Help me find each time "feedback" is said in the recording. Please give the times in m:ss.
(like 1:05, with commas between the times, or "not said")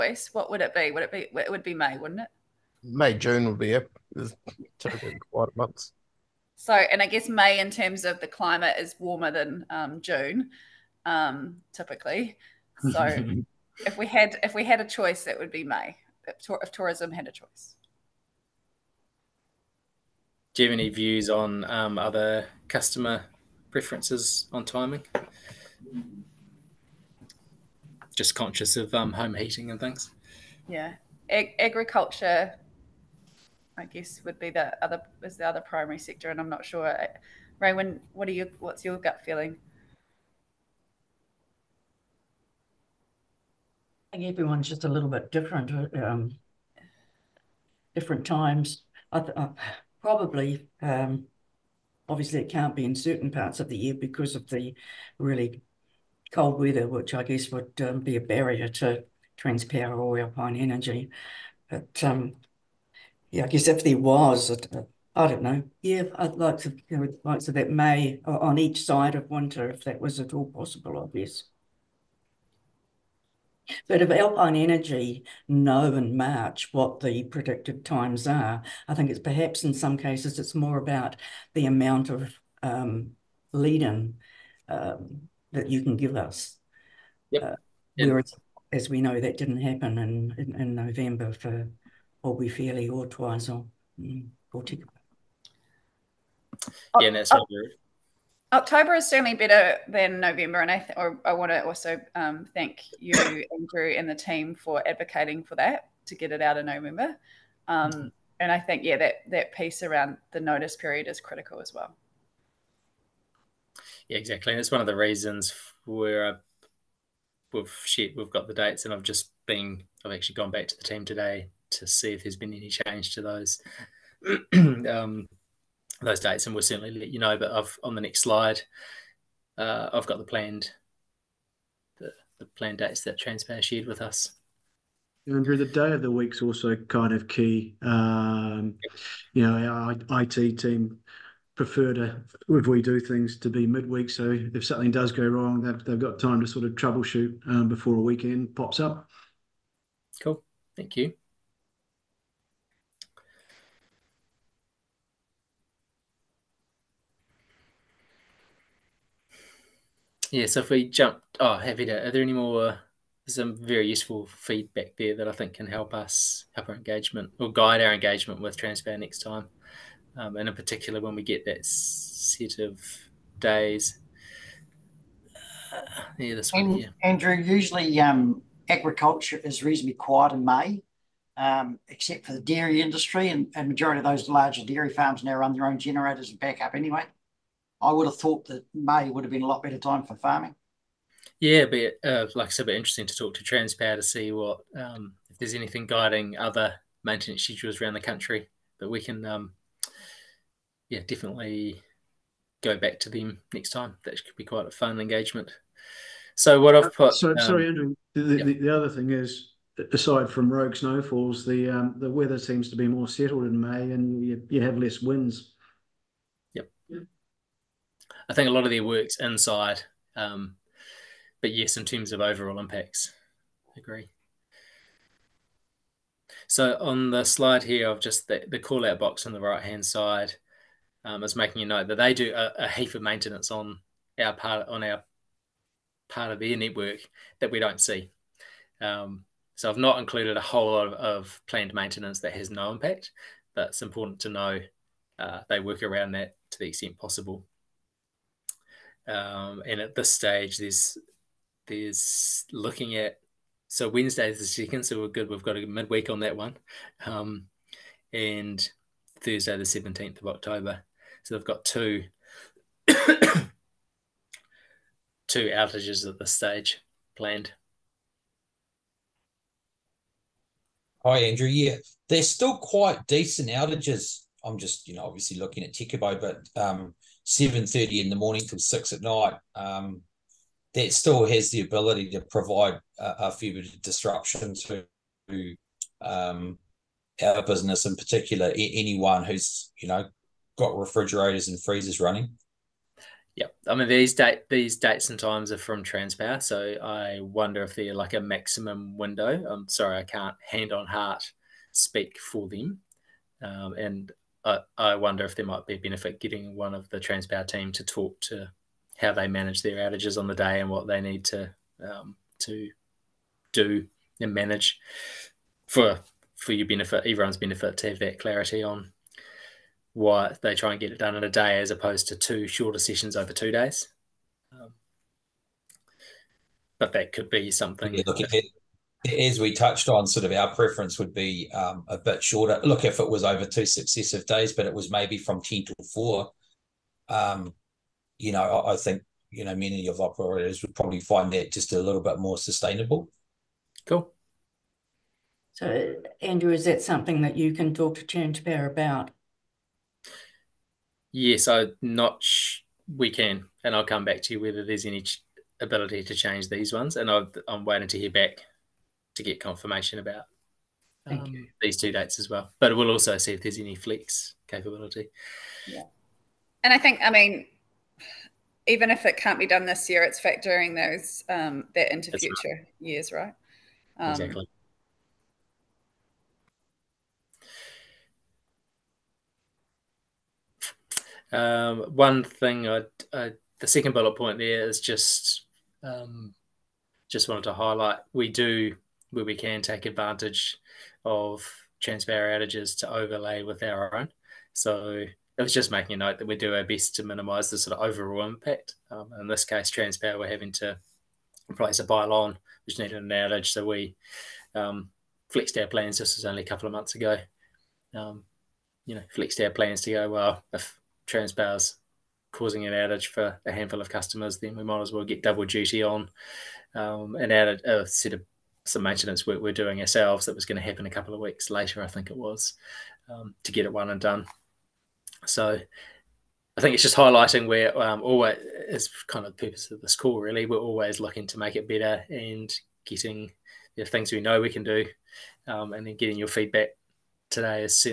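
2:44, 7:16.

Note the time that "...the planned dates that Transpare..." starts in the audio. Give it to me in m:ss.
2:12.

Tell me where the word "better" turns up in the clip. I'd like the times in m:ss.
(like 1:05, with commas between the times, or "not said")
1:39, 3:09, 7:11.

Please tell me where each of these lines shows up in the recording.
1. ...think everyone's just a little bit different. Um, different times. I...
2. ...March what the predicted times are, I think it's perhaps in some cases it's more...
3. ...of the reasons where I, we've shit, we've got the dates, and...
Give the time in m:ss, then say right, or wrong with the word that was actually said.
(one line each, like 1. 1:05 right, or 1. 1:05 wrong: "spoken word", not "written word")
1. 0:44 right
2. 1:16 right
3. 1:54 right.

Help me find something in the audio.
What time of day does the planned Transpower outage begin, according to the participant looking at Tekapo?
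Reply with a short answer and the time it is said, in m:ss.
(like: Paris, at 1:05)
7:30 am, at 4:37.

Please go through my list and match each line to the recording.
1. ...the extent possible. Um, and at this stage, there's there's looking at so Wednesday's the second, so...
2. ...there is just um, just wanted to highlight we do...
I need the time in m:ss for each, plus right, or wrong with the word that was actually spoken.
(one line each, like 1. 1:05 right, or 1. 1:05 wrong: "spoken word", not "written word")
1. 4:06 right
2. 6:24 right.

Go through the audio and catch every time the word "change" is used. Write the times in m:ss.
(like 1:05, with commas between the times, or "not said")
2:02, 5:56.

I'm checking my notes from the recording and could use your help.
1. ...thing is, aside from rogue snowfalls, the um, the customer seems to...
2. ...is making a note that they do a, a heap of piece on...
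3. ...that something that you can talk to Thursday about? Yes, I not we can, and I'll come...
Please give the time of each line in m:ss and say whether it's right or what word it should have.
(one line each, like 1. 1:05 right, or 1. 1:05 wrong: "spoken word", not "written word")
1. 3:28 wrong: "weather", not "customer"
2. 3:51 wrong: "maintenance", not "piece"
3. 5:46 wrong: "Transpower", not "Thursday".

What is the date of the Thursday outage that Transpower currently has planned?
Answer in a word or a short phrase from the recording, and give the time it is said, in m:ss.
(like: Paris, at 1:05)
17 October, at 4:19.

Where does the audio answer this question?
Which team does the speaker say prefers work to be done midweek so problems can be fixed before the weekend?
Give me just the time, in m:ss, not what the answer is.
2:20.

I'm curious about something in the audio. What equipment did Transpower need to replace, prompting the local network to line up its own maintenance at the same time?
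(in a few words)
A pylon.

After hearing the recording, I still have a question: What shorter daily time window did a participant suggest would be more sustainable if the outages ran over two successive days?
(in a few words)
10 to 4.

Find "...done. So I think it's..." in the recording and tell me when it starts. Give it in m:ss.
7:03.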